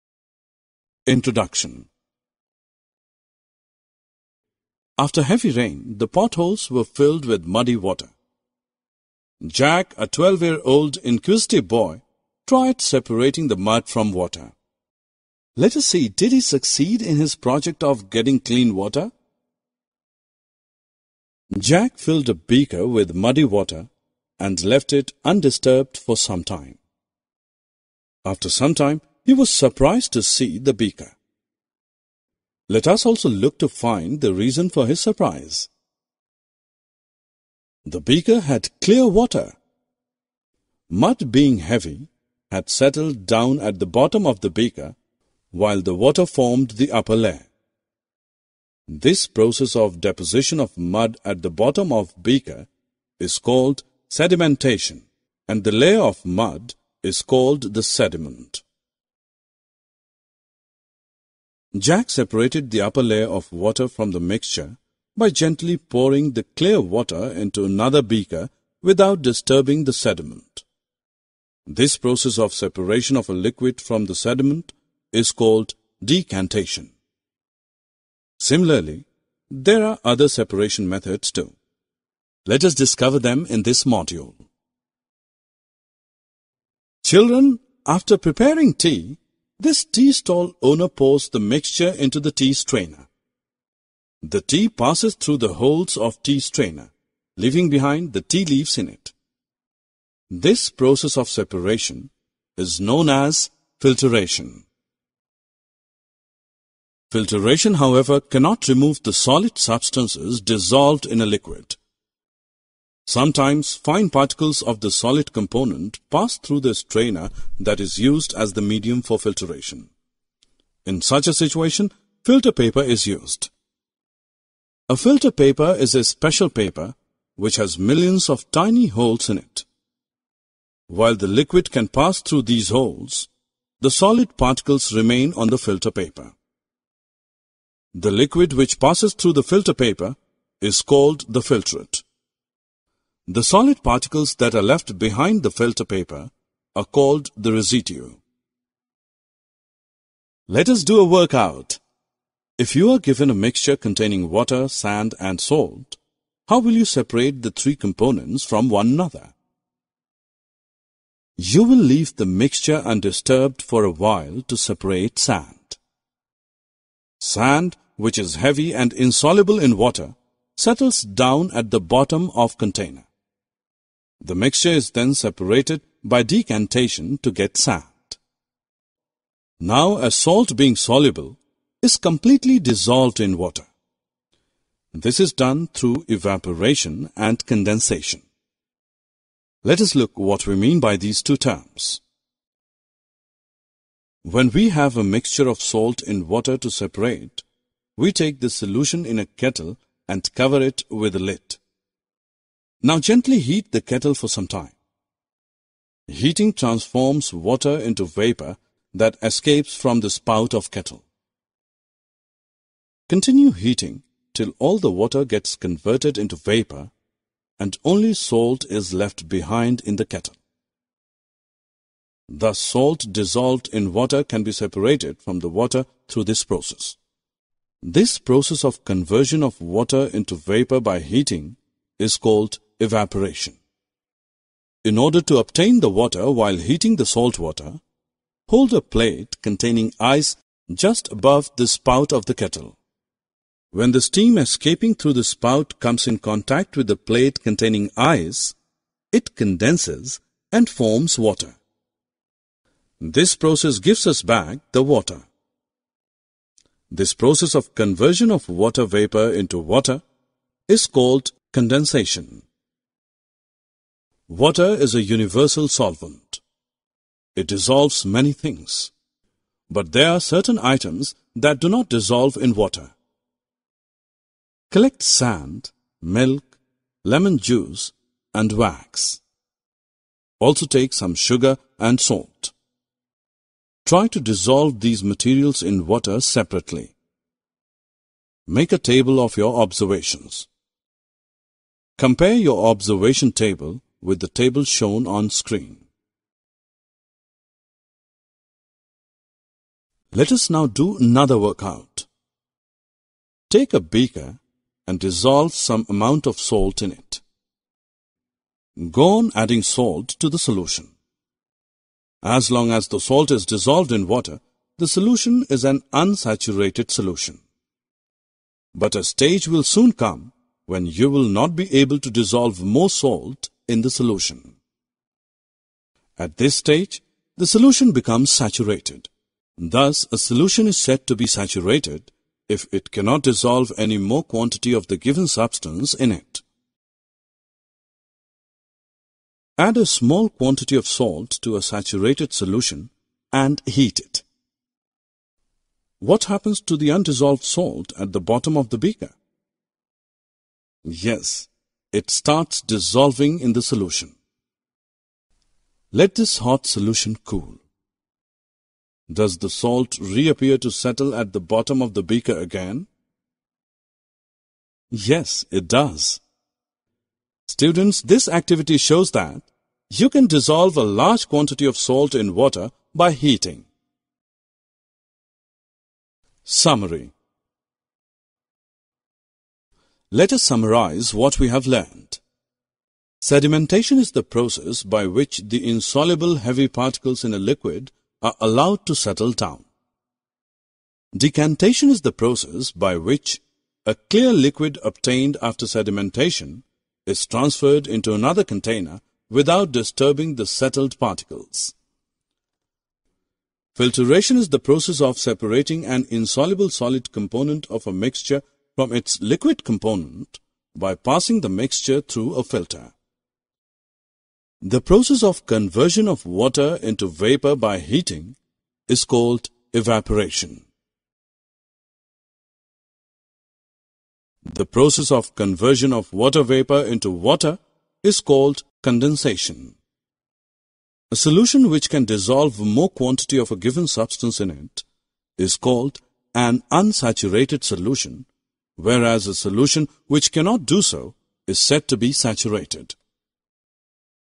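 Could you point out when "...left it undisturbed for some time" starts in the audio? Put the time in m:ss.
0:24.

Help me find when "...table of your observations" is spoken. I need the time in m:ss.
4:48.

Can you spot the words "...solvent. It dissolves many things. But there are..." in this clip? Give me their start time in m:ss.
4:25.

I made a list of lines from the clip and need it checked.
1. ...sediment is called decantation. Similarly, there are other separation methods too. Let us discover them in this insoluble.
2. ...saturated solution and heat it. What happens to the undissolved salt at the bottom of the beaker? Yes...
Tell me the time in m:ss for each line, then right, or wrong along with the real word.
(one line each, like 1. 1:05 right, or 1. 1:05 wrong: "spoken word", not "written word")
1. 1:14 wrong: "module", not "insoluble"
2. 5:41 right.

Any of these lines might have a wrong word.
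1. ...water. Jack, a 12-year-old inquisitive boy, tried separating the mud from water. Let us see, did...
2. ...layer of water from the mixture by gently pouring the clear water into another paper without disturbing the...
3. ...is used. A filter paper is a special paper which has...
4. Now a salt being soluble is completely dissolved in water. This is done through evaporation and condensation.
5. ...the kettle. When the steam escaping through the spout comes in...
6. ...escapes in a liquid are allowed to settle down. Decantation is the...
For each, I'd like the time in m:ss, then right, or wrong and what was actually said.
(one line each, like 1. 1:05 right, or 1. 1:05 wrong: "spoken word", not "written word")
1. 0:07 right
2. 1:03 wrong: "beaker", not "paper"
3. 2:02 right
4. 2:59 right
5. 4:02 right
6. 6:26 wrong: "particles", not "escapes".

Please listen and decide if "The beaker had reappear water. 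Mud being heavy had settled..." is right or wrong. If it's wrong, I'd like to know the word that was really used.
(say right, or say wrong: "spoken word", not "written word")
wrong: "clear", not "reappear".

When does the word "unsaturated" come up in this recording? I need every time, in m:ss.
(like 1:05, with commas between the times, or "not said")
5:15, 7:16.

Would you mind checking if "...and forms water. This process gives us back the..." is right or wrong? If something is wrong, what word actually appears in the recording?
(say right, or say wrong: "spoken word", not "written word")
right.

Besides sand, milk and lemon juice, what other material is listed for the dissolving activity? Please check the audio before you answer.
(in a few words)
Wax.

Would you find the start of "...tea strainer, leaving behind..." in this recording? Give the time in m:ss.
1:36.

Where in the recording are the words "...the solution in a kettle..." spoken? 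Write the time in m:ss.
3:18.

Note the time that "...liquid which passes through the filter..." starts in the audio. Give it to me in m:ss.
2:18.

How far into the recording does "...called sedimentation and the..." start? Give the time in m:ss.
0:53.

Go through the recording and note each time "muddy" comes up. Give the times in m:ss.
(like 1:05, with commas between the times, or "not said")
0:07, 0:23.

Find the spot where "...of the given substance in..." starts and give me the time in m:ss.
5:34.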